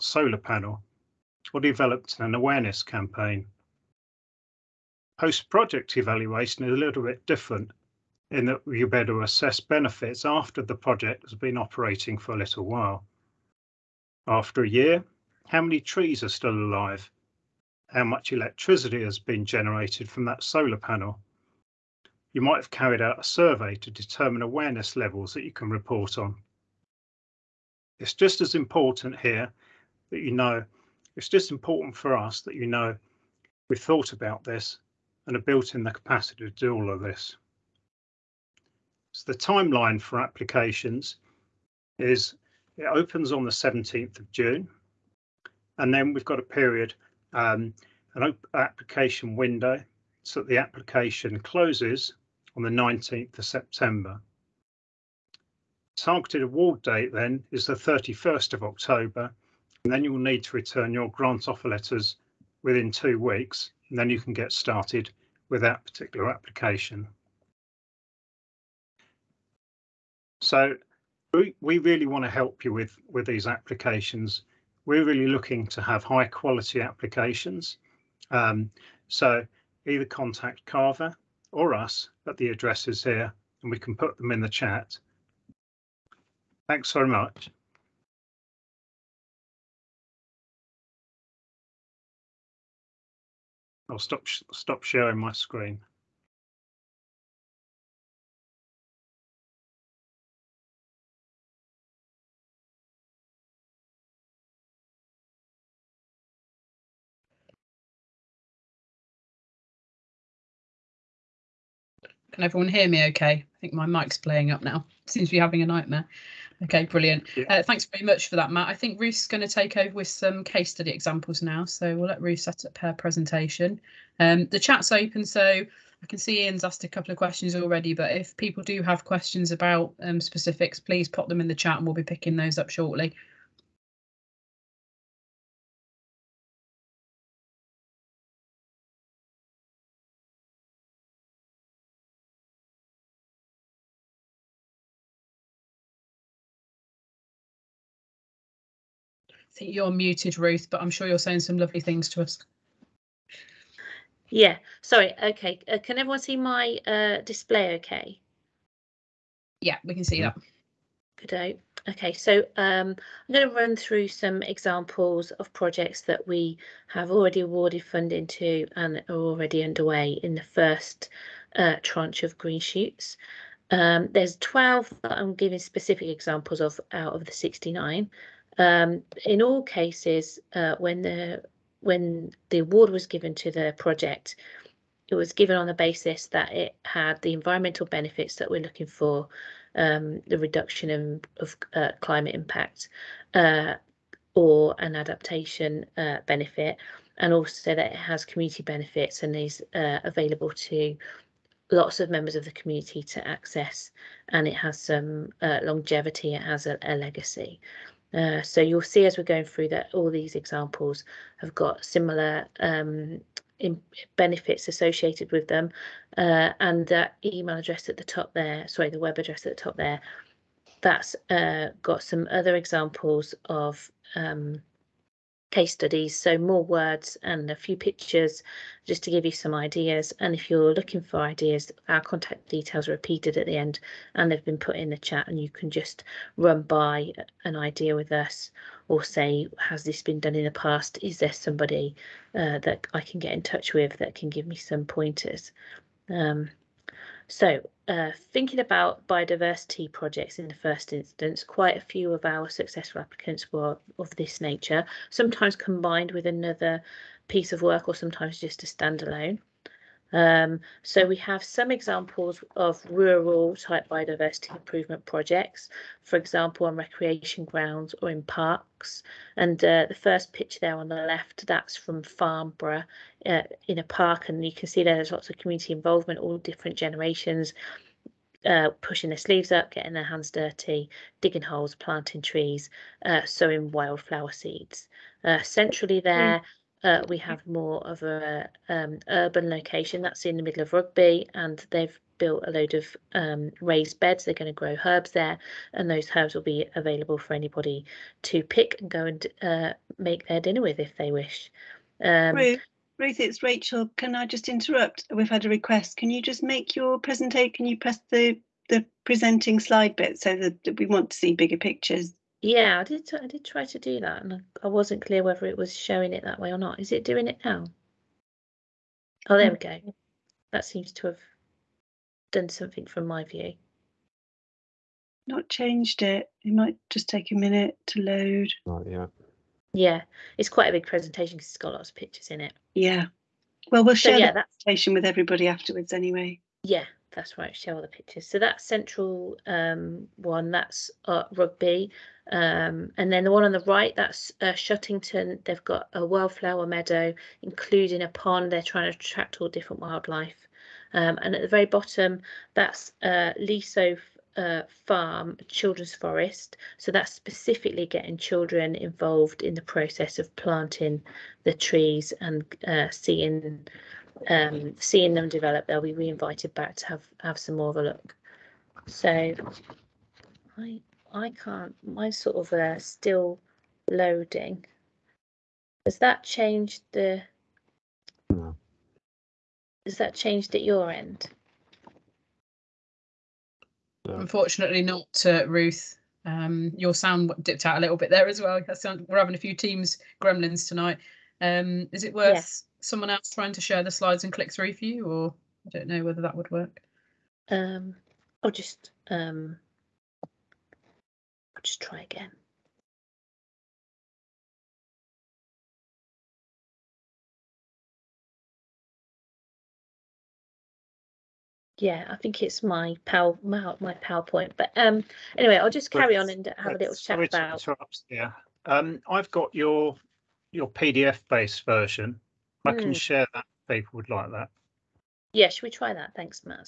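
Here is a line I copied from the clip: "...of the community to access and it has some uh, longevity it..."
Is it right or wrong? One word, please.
right.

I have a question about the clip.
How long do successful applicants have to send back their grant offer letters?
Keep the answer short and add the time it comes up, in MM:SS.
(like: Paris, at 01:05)
two weeks, at 01:02.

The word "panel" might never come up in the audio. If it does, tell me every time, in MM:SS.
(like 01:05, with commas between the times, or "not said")
00:00, 00:20.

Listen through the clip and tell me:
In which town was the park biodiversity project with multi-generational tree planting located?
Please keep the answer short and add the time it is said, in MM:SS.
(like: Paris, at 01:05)
Farnborough, at 04:32.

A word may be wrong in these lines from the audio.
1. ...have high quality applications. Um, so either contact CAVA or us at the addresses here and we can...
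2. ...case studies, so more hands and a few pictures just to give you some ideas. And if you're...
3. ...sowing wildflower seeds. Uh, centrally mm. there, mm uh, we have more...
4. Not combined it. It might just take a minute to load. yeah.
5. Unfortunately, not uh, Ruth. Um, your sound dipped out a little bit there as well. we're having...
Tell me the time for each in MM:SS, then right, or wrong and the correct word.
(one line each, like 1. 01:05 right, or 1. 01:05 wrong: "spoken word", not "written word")
1. 01:15 right
2. 03:45 wrong: "words", not "hands"
3. 04:43 right
4. 05:25 wrong: "changed", not "combined"
5. 06:24 right.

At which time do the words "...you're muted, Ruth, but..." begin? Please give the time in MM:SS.
02:29.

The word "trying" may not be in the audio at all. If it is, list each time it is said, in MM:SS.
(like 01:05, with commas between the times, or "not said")
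05:48, 06:33.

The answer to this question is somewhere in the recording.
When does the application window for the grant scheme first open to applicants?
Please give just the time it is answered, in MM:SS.
00:43.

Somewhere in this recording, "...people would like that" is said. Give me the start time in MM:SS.
07:03.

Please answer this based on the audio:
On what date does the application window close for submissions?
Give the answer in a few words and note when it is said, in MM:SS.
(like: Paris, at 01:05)
19th of September, at 00:52.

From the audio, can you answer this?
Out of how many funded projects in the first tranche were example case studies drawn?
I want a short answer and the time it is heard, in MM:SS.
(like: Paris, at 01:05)
69, at 02:57.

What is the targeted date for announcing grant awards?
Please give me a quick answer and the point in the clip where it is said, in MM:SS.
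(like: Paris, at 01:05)
31st of October, at 00:57.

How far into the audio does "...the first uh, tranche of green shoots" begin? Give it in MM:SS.
02:50.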